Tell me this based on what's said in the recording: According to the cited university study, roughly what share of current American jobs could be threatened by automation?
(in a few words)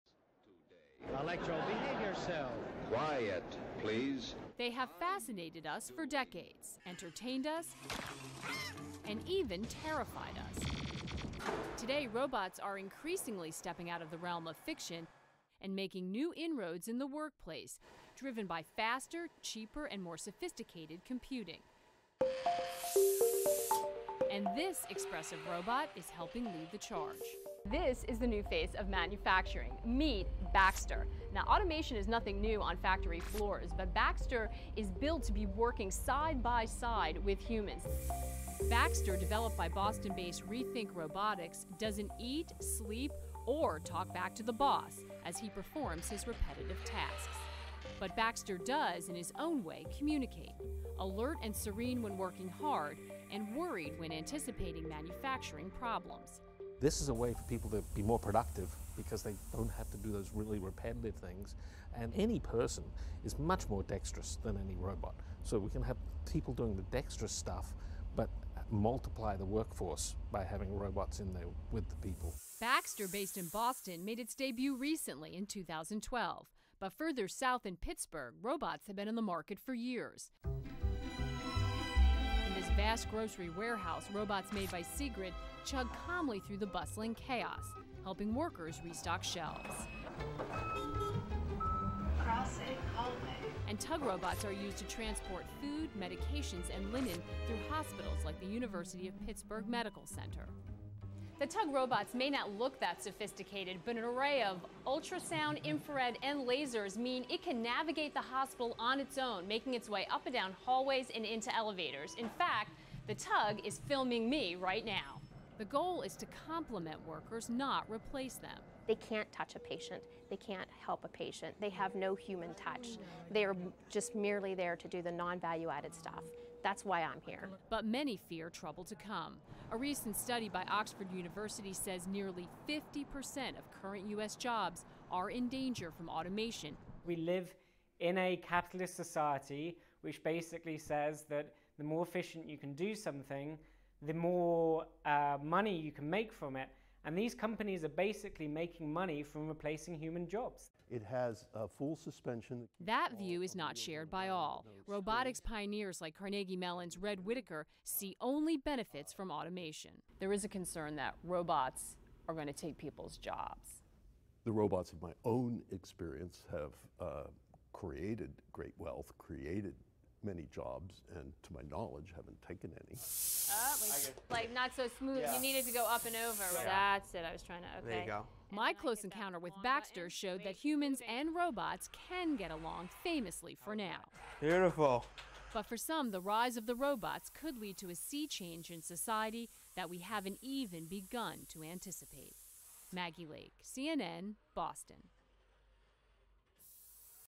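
50%.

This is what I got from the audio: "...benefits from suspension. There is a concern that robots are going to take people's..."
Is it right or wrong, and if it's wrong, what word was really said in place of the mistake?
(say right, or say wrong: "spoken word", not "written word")
wrong: "automation", not "suspension".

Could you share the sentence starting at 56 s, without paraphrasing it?
This is a way for people to be more productive because they don't have to do those really repetitive things.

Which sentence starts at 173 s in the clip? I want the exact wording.
Oh, like, like not so smooth.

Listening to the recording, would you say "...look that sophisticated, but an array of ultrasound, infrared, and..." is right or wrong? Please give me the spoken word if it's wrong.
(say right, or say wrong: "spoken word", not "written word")
right.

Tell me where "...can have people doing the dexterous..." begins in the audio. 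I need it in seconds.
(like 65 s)
65 s.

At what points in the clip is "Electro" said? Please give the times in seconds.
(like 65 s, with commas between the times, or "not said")
1 s.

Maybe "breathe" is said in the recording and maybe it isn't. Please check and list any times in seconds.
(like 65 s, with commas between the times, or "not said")
not said.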